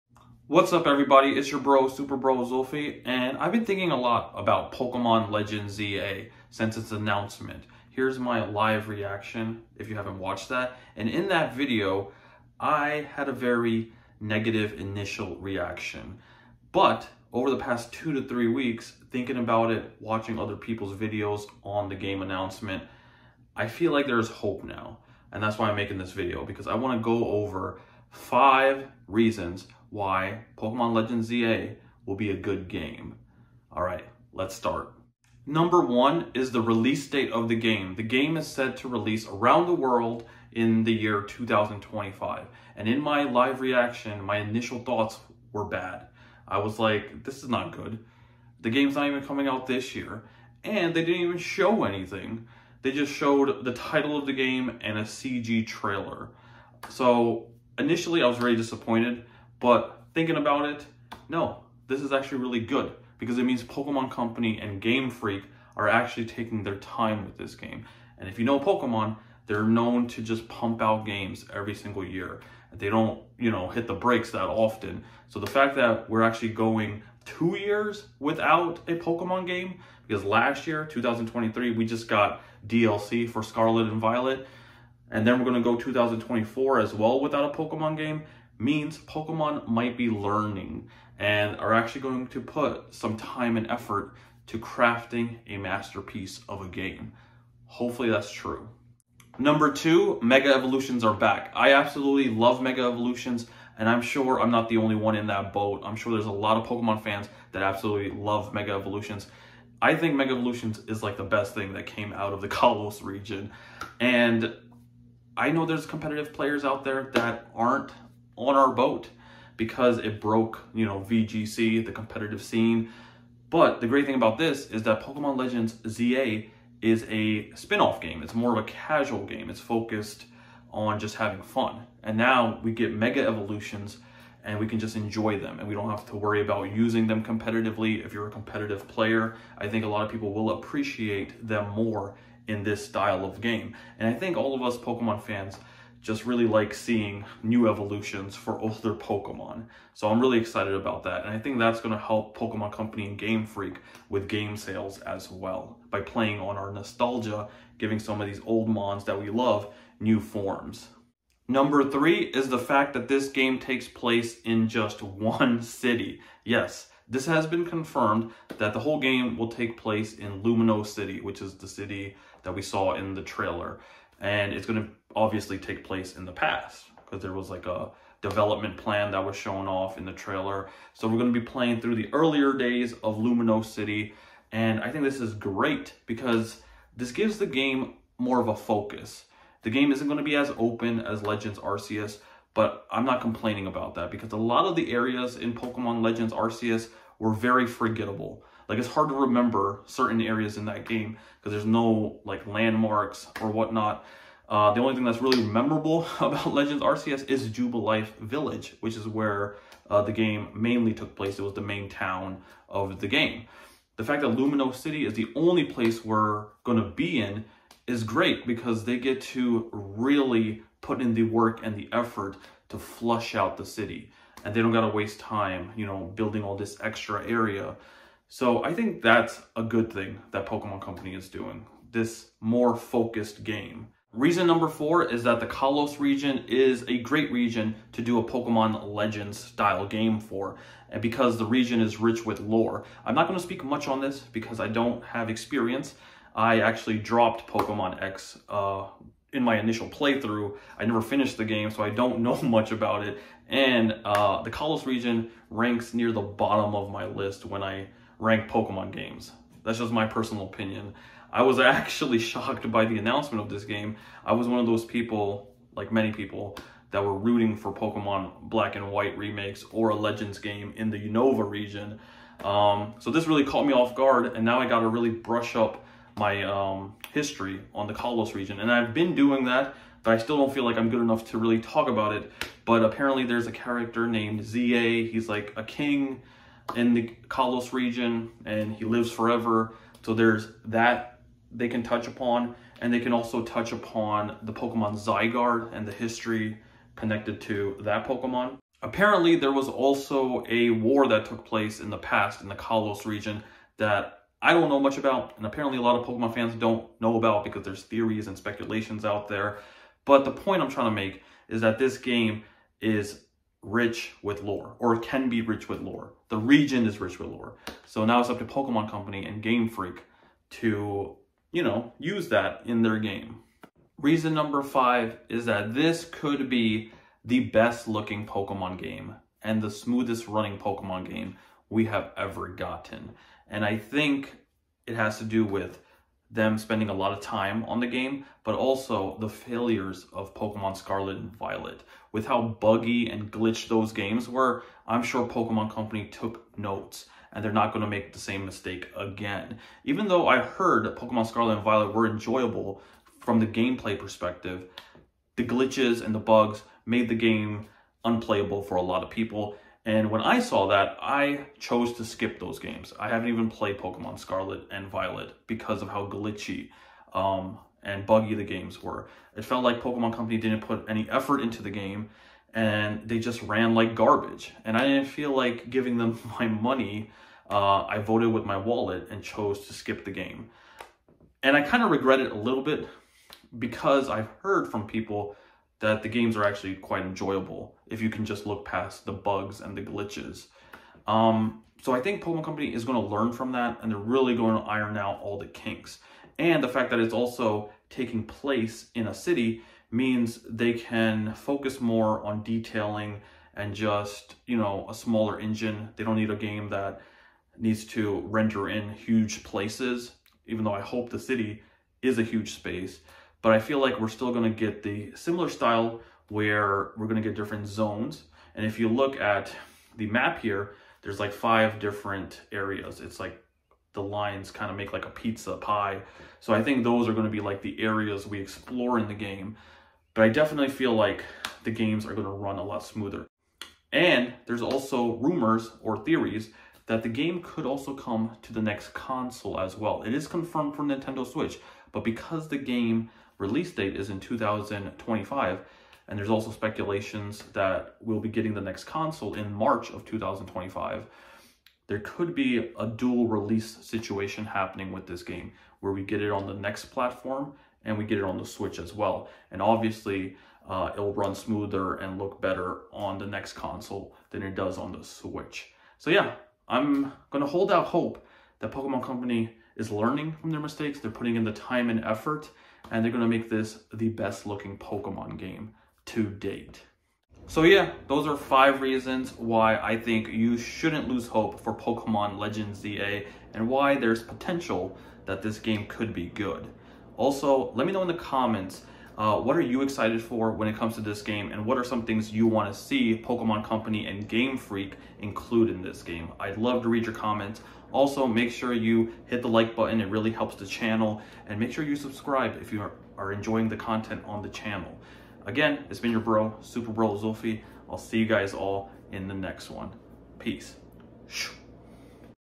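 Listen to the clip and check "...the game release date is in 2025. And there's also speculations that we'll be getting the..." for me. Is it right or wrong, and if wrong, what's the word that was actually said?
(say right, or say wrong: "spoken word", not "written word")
right.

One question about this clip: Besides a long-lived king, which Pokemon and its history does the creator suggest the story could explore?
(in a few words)
Zygarde.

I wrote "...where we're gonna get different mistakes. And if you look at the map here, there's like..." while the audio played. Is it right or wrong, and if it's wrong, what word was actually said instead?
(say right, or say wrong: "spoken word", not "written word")
wrong: "zones", not "mistakes".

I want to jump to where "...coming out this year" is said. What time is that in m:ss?
0:49.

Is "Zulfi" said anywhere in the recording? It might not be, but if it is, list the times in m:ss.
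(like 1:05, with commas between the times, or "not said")
0:02, 8:27.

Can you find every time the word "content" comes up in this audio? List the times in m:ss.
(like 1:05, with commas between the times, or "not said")
8:23.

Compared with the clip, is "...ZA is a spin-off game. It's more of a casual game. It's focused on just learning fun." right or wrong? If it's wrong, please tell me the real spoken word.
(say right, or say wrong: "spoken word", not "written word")
wrong: "having", not "learning".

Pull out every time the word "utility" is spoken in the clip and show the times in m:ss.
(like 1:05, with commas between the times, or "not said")
not said.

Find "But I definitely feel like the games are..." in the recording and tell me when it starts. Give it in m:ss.
7:10.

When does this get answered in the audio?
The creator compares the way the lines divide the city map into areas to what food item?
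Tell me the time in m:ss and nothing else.
7:05.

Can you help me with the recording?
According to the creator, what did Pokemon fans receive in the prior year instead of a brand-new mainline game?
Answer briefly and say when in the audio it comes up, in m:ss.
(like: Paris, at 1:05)
DLC for Scarlet and Violet, at 1:22.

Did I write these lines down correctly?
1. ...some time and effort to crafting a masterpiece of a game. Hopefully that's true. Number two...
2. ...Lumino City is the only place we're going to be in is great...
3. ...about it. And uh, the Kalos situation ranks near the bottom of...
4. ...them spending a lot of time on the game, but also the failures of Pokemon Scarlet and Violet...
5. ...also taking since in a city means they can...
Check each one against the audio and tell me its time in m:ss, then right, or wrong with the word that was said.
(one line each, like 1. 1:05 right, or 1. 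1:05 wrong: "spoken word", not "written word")
1. 1:32 right
2. 3:34 right
3. 4:12 wrong: "region", not "situation"
4. 5:36 right
5. 6:37 wrong: "place", not "since".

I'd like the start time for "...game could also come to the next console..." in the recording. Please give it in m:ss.
7:17.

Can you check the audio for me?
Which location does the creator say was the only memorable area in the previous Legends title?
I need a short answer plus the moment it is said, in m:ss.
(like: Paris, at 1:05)
Jubilife Village, at 3:27.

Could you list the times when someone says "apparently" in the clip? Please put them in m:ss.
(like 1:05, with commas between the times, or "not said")
4:42, 4:58, 5:05.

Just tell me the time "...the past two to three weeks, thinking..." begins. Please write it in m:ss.
0:17.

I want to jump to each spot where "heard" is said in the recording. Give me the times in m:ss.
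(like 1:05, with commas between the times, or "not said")
5:50, 6:24.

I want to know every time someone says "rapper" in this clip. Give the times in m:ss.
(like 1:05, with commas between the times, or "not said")
not said.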